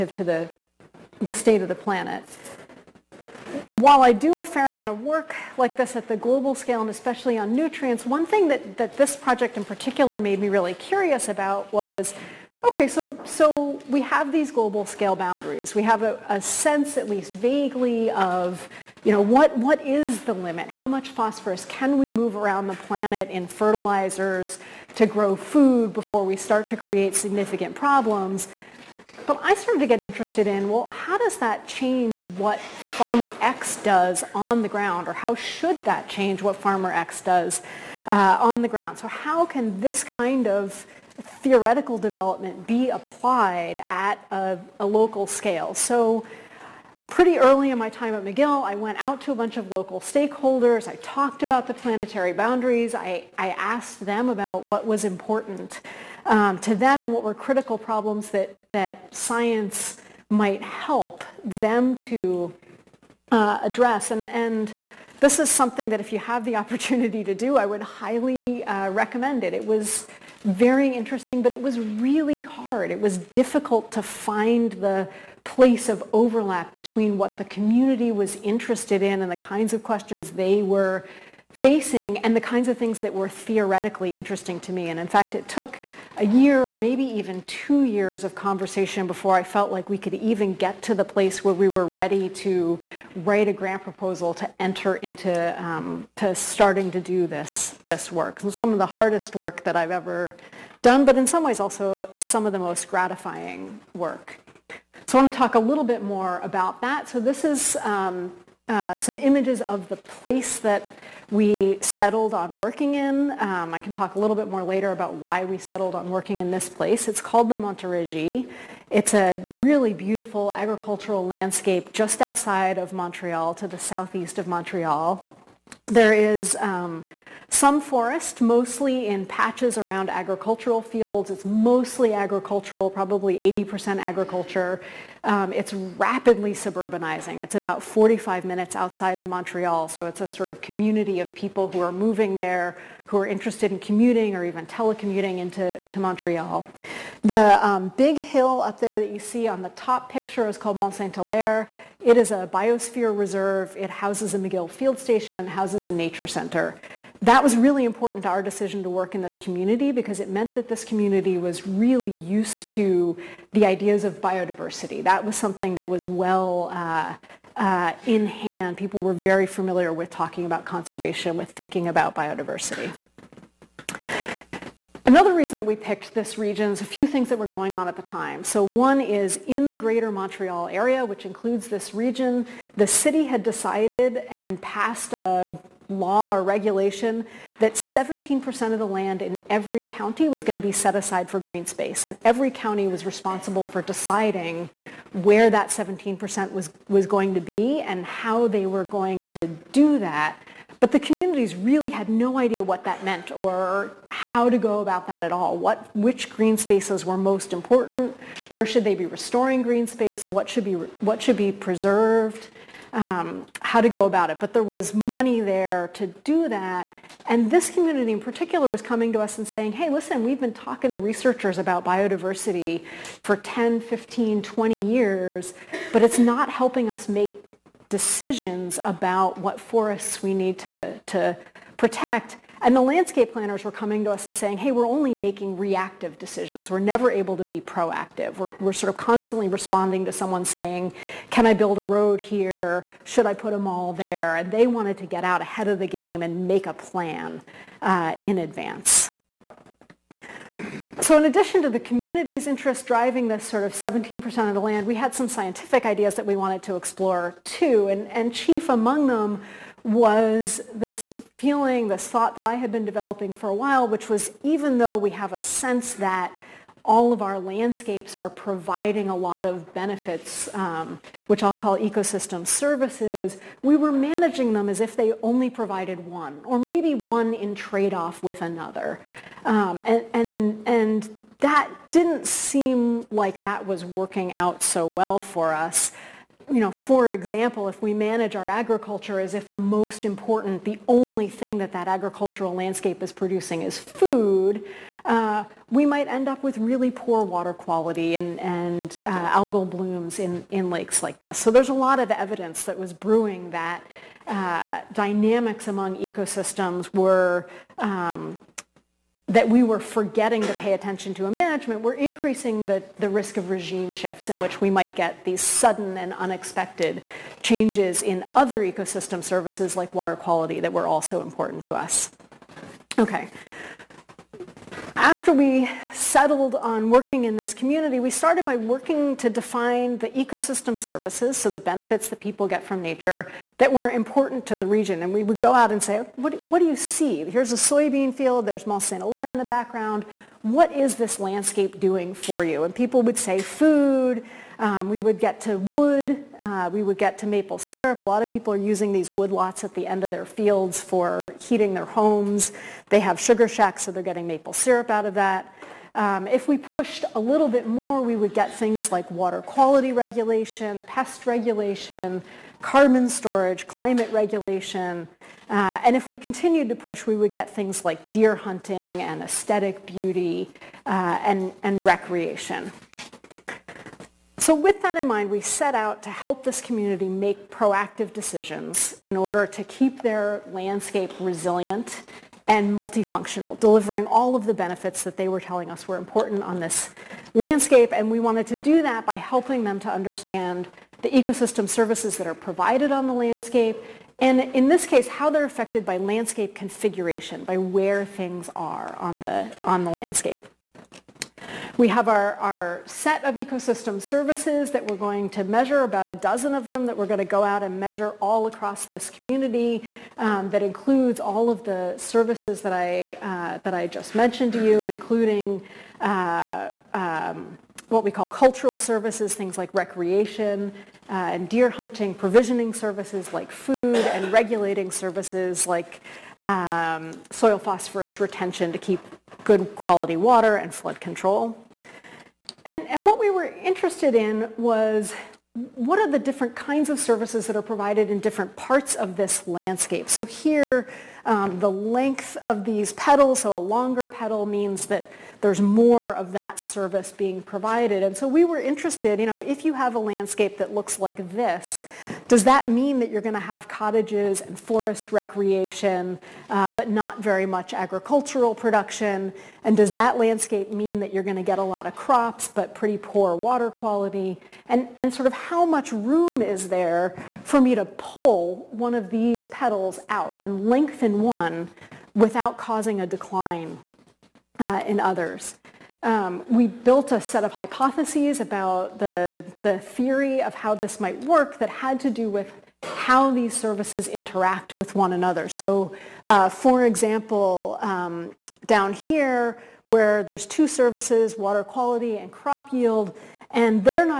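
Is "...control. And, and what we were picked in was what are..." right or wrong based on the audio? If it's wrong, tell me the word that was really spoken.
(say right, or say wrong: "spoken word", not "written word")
wrong: "interested", not "picked".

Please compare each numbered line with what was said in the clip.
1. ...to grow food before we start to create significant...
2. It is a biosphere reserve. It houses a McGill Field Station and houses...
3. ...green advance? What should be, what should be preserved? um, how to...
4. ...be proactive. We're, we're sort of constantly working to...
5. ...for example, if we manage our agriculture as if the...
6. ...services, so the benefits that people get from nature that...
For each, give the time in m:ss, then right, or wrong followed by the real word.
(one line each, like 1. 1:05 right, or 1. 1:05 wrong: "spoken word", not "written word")
1. 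0:24 right
2. 2:32 right
3. 3:29 wrong: "space", not "advance"
4. 3:57 wrong: "responding", not "working"
5. 4:46 right
6. 5:30 right.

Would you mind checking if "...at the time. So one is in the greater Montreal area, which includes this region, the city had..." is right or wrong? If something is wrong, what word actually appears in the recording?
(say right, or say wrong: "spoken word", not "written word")
right.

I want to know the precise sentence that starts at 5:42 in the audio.
And people would say food, um, we would get to wood.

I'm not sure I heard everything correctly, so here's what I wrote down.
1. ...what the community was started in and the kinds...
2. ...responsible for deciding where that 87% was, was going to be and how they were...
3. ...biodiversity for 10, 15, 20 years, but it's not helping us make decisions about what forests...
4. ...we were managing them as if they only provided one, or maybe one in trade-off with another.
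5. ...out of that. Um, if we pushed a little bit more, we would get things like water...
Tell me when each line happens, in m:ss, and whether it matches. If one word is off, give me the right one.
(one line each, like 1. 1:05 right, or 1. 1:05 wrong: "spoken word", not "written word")
1. 1:17 wrong: "interested", not "started"
2. 3:13 wrong: "17", not "87"
3. 3:41 right
4. 4:33 right
5. 5:54 right.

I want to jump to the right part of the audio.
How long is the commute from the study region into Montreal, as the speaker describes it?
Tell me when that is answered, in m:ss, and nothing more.
2:17.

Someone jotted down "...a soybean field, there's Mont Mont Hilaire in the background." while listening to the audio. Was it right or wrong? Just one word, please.
wrong.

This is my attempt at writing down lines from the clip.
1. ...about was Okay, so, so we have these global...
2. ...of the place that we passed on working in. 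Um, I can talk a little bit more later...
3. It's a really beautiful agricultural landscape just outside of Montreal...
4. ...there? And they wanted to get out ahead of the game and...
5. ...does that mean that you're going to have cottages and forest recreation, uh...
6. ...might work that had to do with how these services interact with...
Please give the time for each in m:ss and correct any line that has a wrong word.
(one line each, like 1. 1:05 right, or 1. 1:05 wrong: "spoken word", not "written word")
1. 0:11 right
2. 1:49 wrong: "settled", not "passed"
3. 1:58 right
4. 4:03 right
5. 7:32 right
6. 8:00 right.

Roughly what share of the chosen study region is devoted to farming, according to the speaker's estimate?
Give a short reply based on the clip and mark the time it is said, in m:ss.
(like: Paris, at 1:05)
80%, at 2:13.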